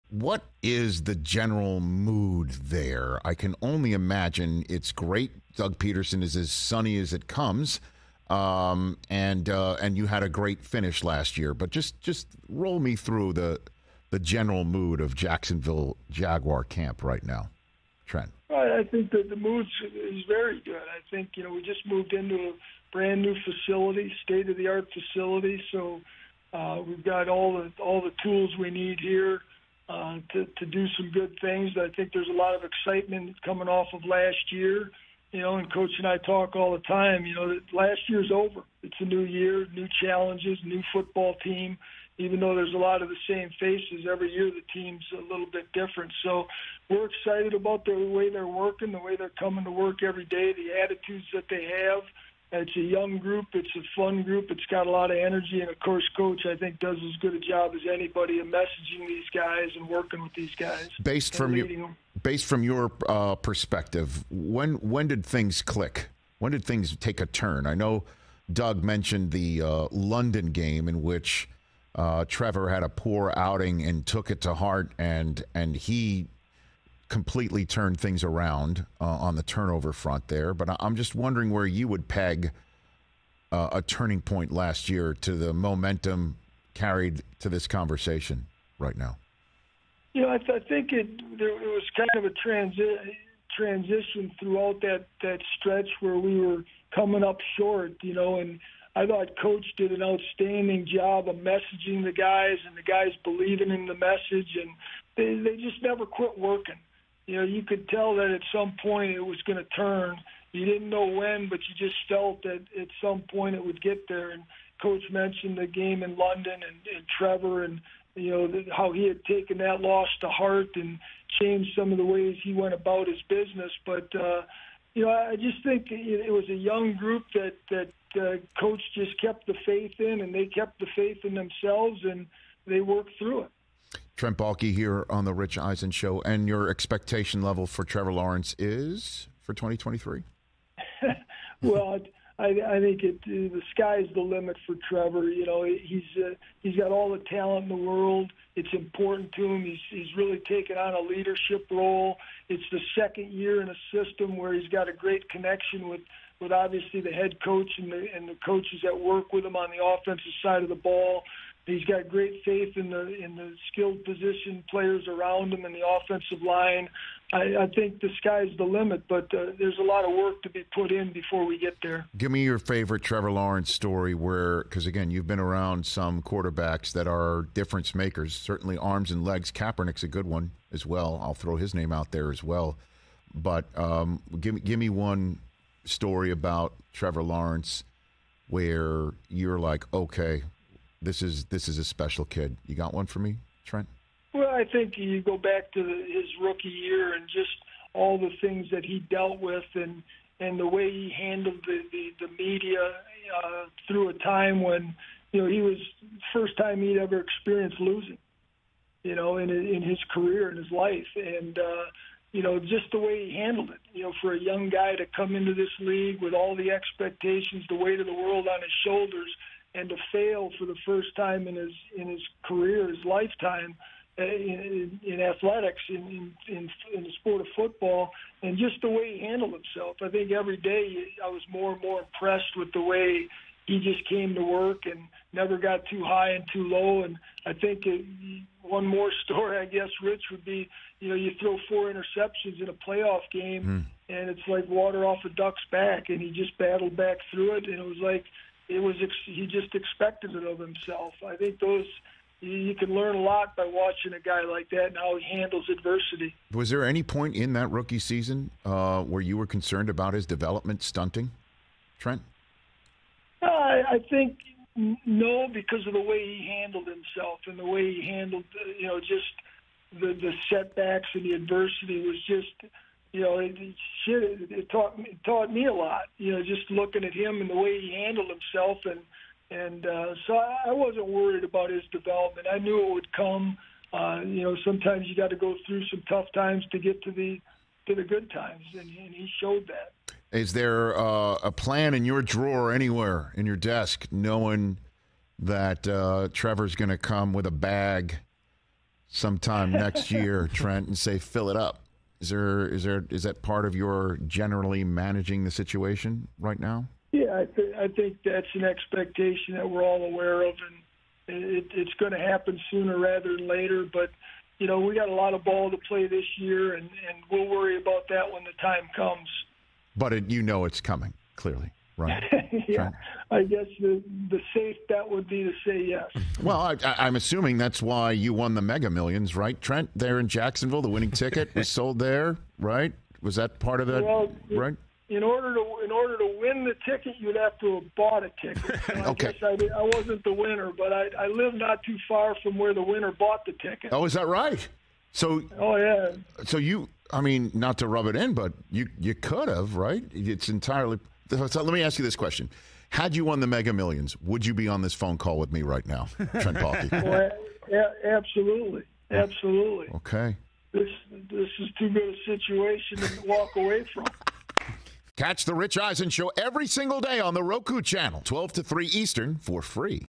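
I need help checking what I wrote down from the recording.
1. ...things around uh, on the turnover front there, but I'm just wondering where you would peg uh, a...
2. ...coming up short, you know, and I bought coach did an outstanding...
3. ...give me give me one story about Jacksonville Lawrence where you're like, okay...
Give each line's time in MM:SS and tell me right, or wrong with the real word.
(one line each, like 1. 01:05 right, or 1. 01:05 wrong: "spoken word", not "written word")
1. 01:17 right
2. 01:36 wrong: "thought", not "bought"
3. 03:04 wrong: "Trevor", not "Jacksonville".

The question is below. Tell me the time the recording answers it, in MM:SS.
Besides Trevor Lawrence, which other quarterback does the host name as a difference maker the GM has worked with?
02:59.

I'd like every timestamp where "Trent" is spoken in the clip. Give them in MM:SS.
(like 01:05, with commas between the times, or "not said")
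00:18, 02:14, 03:13, 04:21, 05:00, 05:29, 05:56.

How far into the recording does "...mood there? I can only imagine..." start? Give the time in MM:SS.
00:01.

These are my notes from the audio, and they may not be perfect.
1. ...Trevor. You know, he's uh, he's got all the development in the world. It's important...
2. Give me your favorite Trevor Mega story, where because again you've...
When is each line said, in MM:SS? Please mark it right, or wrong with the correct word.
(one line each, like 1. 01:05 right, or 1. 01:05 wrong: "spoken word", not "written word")
1. 02:24 wrong: "talent", not "development"
2. 02:52 wrong: "Lawrence", not "Mega".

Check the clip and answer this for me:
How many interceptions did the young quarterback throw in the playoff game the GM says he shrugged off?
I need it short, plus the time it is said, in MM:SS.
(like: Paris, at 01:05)
4, at 04:01.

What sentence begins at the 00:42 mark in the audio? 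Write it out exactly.
Even though there's a lot of the same faces every year, the team's a little bit different.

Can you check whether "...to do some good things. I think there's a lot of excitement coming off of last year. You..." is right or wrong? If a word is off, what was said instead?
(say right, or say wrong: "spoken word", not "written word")
right.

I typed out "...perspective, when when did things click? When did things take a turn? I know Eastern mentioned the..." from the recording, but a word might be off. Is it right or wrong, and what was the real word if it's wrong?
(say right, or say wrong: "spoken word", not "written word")
wrong: "Doug", not "Eastern".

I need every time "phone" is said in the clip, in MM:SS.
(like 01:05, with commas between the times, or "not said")
05:54.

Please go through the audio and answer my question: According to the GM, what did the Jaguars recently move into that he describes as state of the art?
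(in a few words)
Brand new facility.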